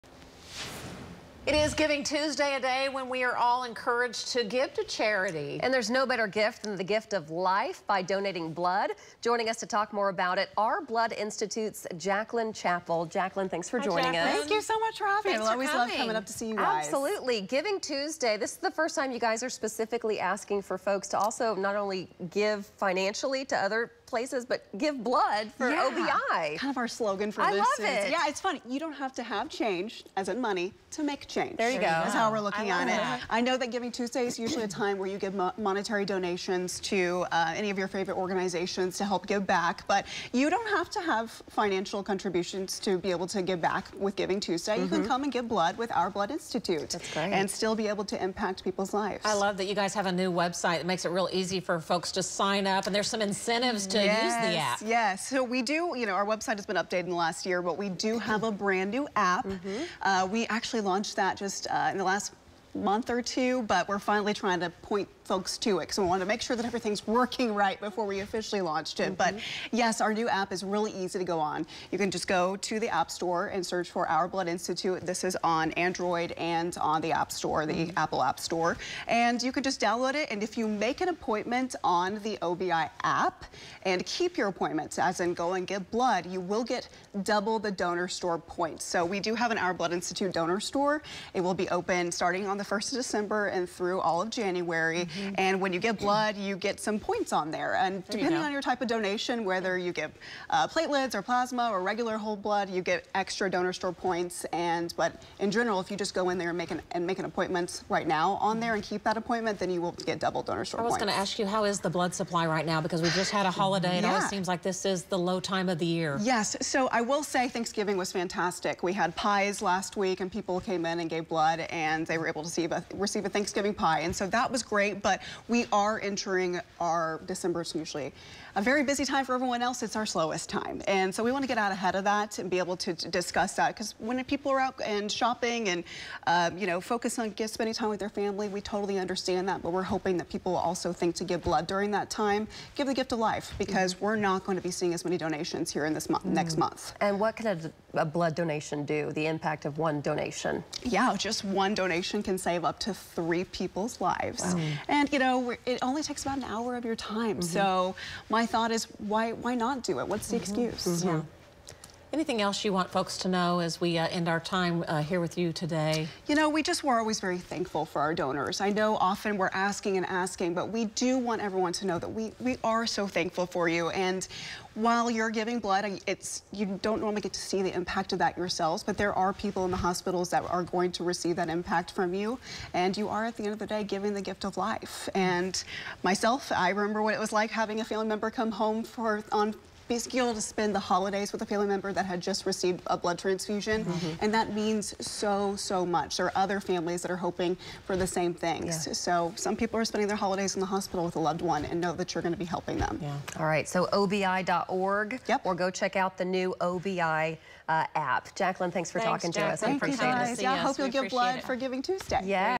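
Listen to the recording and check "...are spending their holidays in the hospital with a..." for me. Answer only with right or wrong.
right.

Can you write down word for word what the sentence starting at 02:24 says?
we're not going to be seeing as many donations here in this month, mm -hmm.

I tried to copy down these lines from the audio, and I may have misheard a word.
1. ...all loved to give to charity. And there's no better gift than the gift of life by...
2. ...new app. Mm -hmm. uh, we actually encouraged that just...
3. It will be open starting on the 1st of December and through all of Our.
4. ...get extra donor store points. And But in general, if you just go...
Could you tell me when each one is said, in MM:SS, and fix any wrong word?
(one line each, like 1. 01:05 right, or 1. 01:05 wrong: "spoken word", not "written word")
1. 00:03 wrong: "encouraged", not "loved"
2. 00:58 wrong: "launched", not "encouraged"
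3. 01:31 wrong: "January", not "Our"
4. 01:42 right.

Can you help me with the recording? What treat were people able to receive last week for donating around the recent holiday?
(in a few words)
Thanksgiving pie.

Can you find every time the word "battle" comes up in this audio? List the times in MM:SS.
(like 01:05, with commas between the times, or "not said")
not said.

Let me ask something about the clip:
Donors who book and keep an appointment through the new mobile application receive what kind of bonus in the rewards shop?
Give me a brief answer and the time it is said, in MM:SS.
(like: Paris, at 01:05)
Double donor store points, at 01:27.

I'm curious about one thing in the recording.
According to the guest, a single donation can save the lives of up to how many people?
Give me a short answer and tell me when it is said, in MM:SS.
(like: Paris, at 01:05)
3, at 02:33.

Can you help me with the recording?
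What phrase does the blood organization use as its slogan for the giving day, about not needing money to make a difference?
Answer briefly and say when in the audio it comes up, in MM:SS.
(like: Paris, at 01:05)
You don't have to have change, at 00:28.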